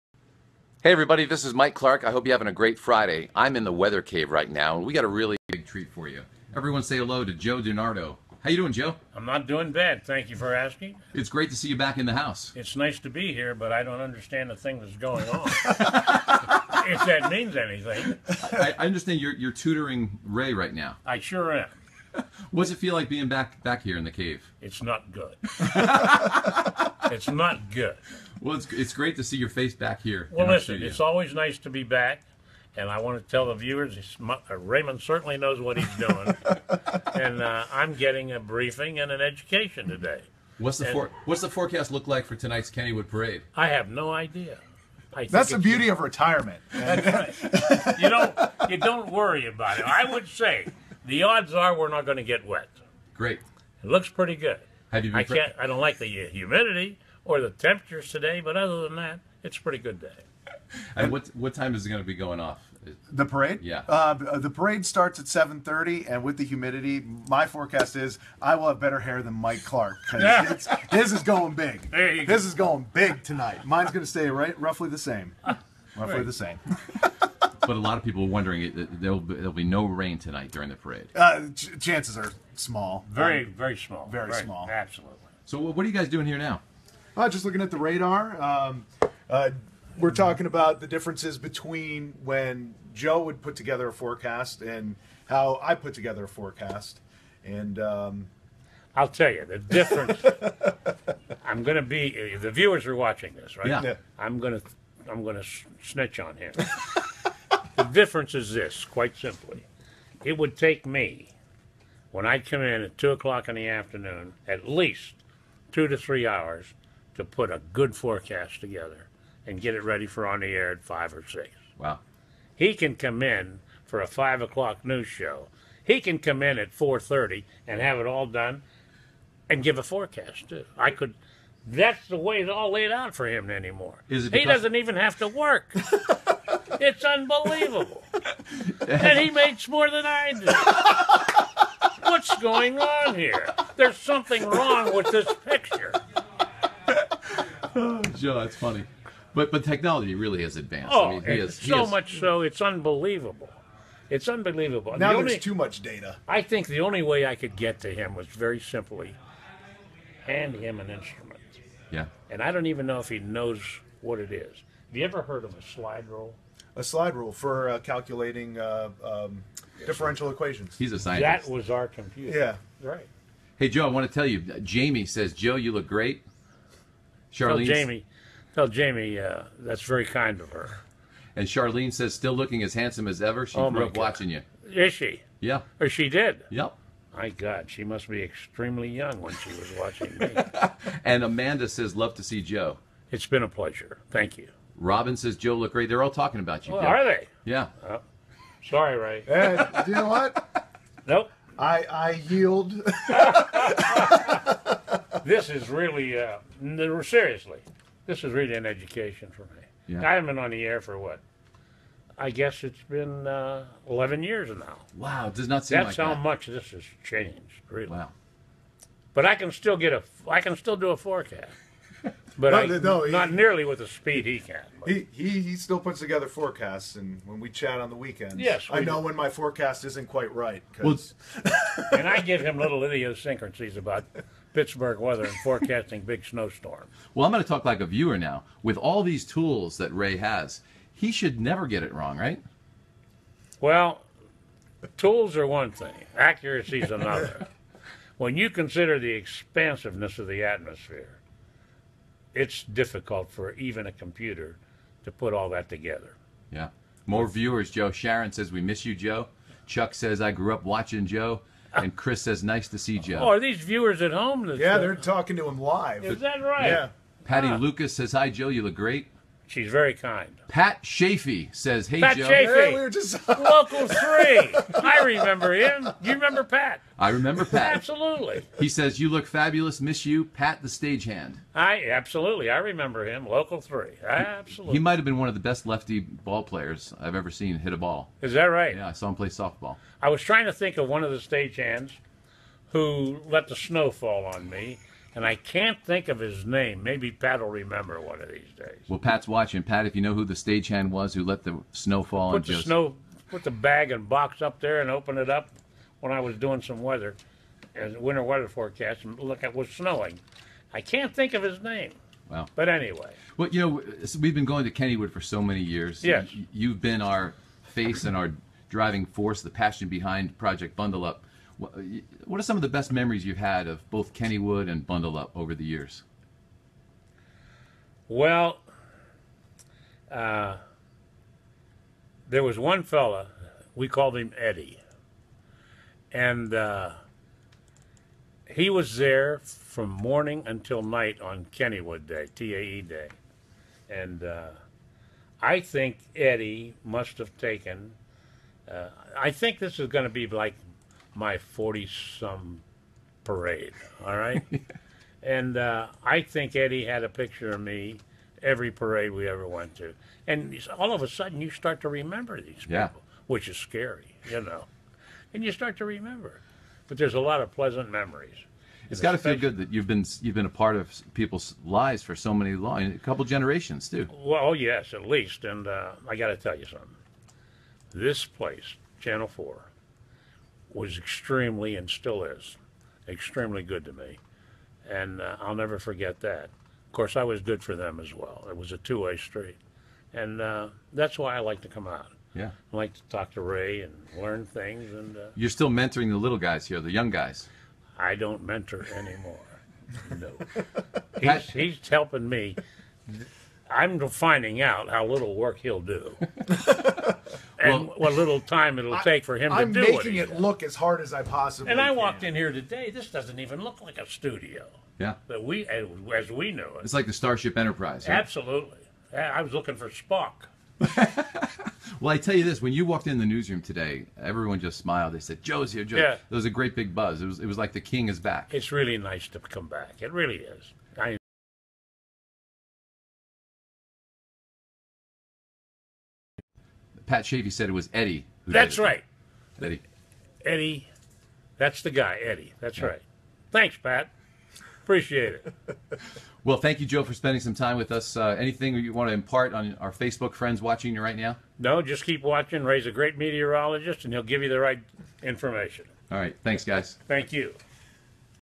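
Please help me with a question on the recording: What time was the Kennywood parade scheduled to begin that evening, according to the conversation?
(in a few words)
7:30.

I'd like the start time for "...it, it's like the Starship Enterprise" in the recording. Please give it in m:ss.
6:56.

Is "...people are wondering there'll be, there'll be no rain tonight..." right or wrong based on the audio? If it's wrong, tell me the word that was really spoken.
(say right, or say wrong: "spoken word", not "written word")
right.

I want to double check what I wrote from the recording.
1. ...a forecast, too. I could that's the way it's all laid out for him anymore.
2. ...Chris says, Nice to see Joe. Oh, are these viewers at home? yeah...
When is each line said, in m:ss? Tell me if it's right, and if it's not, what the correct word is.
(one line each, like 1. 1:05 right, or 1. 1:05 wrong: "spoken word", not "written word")
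1. 2:09 right
2. 4:21 right.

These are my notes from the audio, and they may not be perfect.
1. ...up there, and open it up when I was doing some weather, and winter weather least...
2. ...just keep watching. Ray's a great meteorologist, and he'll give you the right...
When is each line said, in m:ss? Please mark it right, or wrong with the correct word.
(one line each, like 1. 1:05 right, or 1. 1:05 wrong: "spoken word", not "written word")
1. 5:04 wrong: "forecast", not "least"
2. 7:31 right.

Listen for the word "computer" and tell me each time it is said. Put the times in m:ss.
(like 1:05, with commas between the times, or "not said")
2:51, 4:13.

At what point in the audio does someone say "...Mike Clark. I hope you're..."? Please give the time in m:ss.
0:01.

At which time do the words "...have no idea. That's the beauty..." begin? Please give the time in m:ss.
0:43.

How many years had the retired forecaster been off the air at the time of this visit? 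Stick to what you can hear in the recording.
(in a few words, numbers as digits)
11.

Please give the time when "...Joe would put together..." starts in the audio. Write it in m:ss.
1:32.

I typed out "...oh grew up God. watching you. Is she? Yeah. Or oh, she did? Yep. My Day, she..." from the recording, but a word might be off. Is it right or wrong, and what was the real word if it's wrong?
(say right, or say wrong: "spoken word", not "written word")
wrong: "God", not "Day".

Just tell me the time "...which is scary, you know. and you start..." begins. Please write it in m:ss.
6:03.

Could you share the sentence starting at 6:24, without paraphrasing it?
And uh, I'll never forget that.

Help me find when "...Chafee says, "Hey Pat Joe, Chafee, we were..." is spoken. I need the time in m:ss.
4:30.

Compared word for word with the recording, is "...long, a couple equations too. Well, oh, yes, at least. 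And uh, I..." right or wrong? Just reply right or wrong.
wrong.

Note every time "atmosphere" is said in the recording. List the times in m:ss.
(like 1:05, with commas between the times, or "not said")
4:10.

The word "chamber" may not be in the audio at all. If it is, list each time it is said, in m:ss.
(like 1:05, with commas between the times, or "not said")
not said.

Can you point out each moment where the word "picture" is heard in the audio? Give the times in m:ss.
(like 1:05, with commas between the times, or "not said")
2:25, 5:57.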